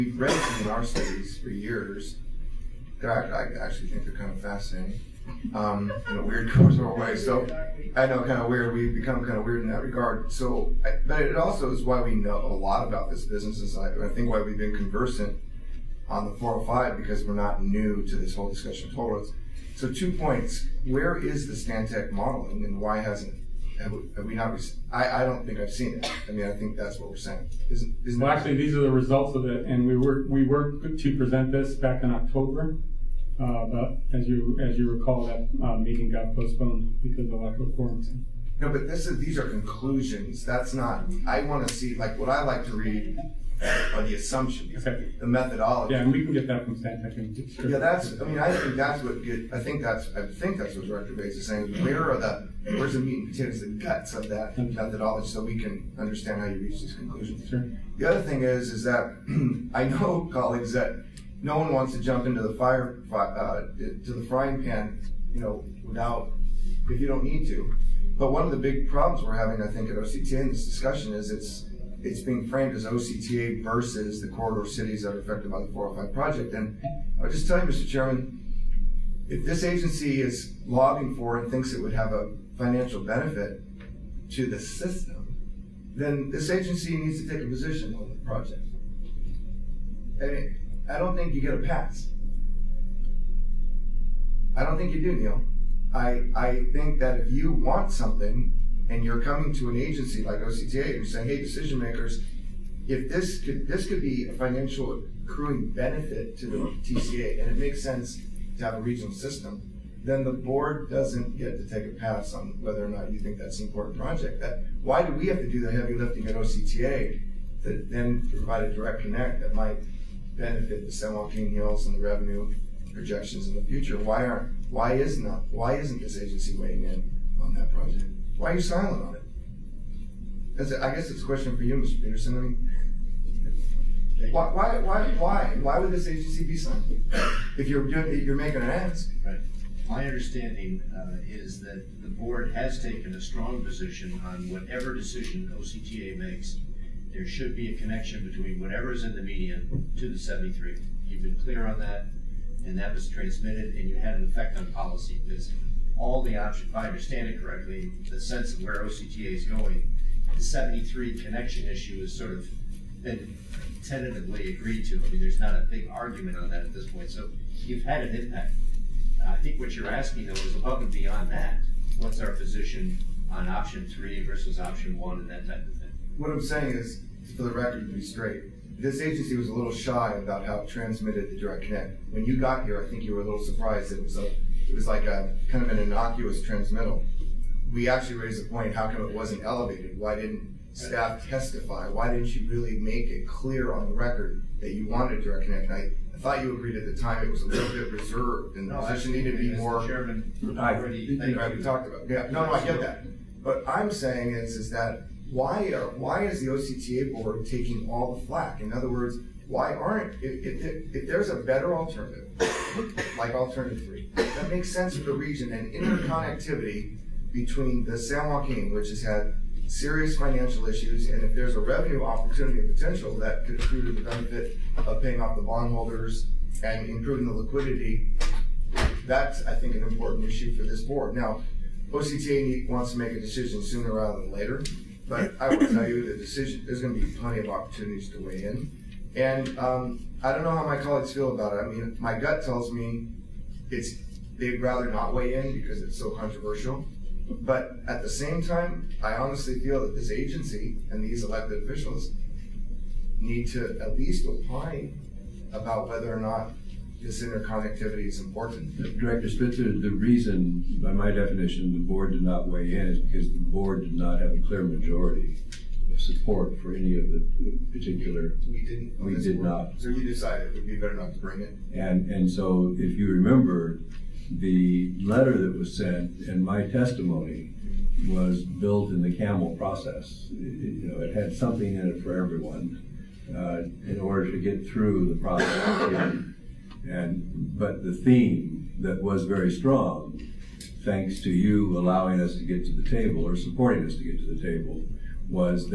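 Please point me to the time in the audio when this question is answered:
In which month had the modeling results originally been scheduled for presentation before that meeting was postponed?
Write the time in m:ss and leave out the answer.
0:32.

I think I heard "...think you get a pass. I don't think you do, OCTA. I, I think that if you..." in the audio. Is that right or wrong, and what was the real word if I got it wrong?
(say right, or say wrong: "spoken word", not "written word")
wrong: "Neil", not "OCTA".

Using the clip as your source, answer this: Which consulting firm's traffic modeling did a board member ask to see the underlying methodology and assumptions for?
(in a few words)
Stantec.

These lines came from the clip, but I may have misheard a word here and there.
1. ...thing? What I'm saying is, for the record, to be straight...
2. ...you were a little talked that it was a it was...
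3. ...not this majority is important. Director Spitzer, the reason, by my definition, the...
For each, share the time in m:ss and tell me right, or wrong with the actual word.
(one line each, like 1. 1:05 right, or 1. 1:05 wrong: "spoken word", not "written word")
1. 2:55 right
2. 3:03 wrong: "surprised", not "talked"
3. 4:16 wrong: "interconnectivity", not "majority".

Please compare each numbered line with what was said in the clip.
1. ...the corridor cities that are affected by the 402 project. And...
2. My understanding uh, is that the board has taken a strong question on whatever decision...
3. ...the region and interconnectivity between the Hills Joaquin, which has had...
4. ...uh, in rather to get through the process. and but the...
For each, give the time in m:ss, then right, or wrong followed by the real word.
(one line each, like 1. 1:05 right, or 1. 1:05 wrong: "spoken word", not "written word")
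1. 1:14 wrong: "405", not "402"
2. 2:19 wrong: "position", not "question"
3. 3:35 wrong: "San", not "Hills"
4. 4:43 wrong: "order", not "rather".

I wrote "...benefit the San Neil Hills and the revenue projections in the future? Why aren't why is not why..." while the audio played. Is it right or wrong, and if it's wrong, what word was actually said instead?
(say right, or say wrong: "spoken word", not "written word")
wrong: "Joaquin", not "Neil".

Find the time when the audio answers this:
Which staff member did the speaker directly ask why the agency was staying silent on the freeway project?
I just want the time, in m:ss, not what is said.
2:11.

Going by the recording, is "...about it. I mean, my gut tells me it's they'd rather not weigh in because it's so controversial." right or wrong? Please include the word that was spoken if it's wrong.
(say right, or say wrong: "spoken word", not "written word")
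right.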